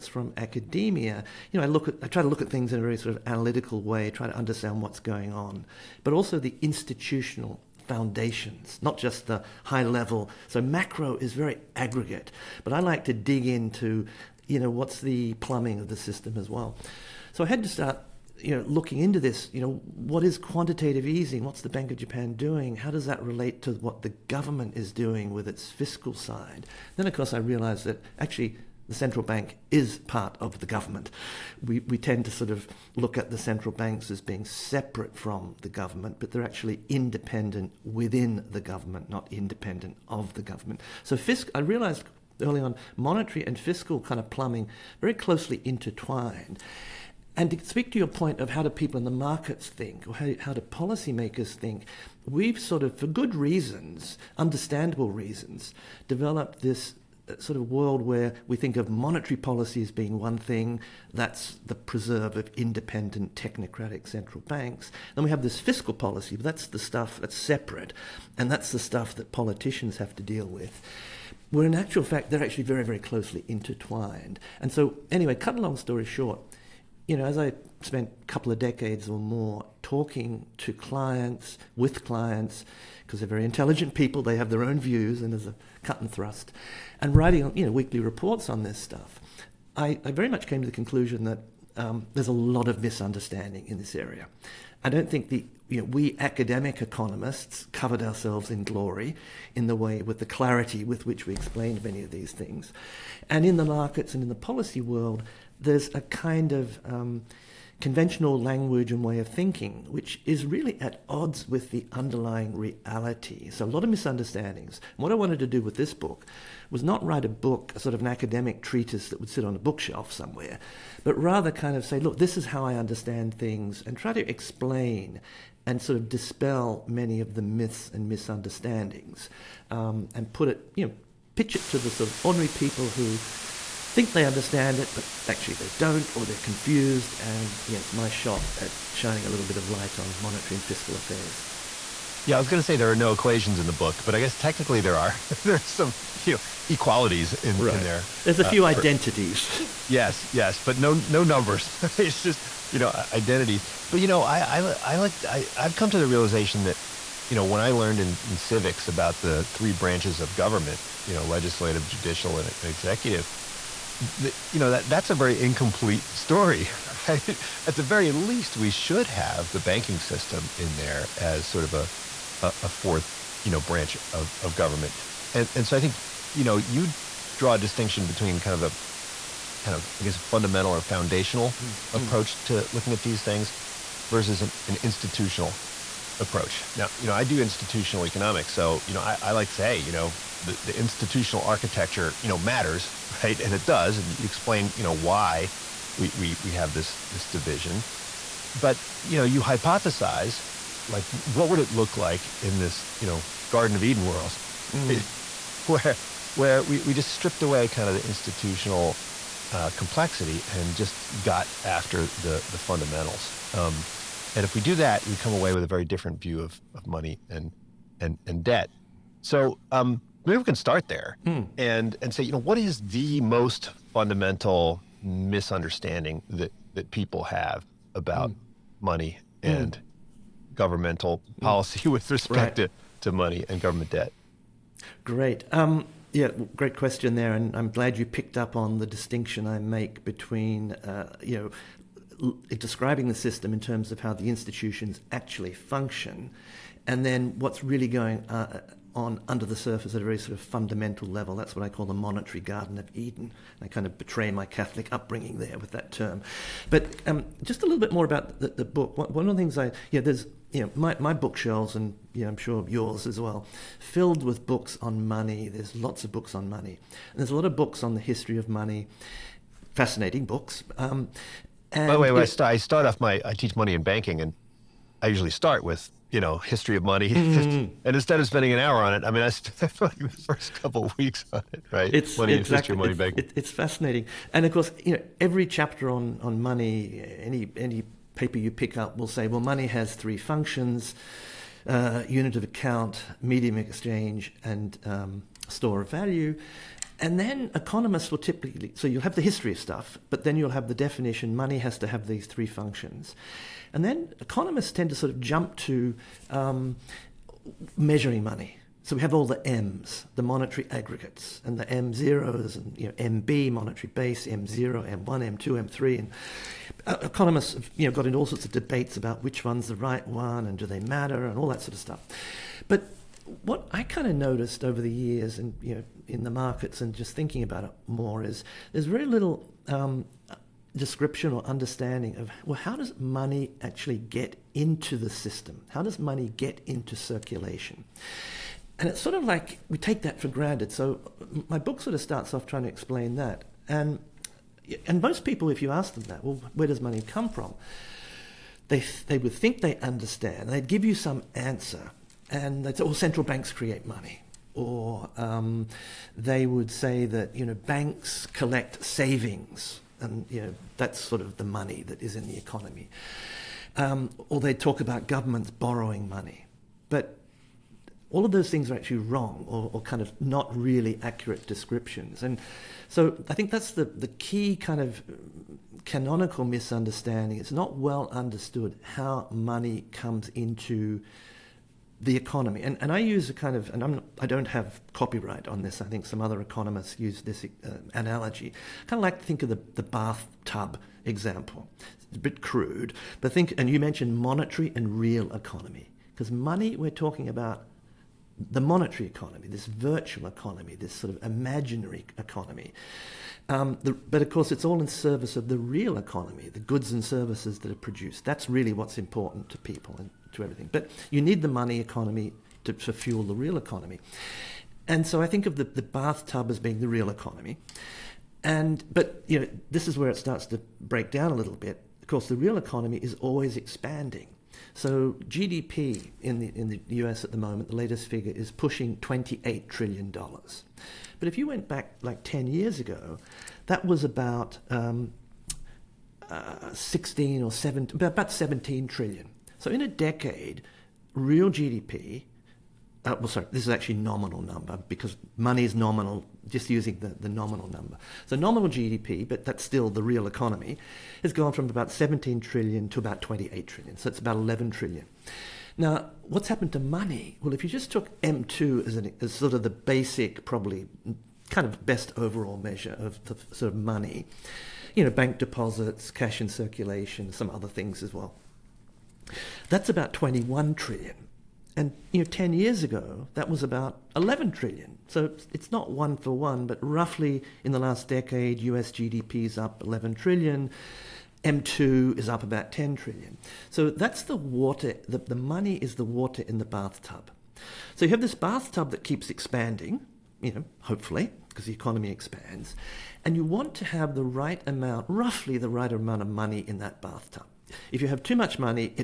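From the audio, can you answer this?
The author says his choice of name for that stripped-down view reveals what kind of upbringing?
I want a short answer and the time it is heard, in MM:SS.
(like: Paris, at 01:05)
Catholic, at 04:14.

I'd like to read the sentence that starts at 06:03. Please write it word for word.
Um, or they talk about governments borrowing money.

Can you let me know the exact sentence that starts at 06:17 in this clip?
It's not well understood how money comes into the economy.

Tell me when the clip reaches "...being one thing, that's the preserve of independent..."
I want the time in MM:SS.
00:59.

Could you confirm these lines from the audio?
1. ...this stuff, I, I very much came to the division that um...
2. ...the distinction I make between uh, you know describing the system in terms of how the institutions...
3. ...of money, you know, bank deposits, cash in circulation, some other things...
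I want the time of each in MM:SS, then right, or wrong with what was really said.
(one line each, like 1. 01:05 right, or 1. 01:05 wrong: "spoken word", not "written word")
1. 01:28 wrong: "conclusion", not "division"
2. 03:58 right
3. 07:43 right.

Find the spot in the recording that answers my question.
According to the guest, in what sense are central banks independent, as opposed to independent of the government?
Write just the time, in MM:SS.
00:36.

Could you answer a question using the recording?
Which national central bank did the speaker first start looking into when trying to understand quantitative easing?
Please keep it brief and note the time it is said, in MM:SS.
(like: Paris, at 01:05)
Bank of Japan, at 00:21.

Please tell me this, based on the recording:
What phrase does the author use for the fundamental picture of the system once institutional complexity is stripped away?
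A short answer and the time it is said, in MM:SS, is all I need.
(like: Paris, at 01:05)
Monetary Garden of Eden, at 04:11.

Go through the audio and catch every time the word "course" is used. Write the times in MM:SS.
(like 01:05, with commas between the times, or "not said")
00:27, 04:44, 06:44, 07:02.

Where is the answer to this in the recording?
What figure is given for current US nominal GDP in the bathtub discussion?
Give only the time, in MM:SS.
07:08.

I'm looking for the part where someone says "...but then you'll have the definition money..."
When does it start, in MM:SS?
05:00.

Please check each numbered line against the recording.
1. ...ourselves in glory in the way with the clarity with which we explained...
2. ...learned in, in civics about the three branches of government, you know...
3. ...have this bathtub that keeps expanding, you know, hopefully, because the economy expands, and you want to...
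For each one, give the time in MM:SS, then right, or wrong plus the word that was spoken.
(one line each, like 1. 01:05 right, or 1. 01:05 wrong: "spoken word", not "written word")
1. 01:38 right
2. 02:37 right
3. 08:08 right.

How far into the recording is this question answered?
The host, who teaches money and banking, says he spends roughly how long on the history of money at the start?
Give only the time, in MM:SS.
04:39.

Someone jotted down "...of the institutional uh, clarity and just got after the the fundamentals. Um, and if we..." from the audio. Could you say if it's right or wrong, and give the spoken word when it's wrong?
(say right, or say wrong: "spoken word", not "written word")
wrong: "complexity", not "clarity".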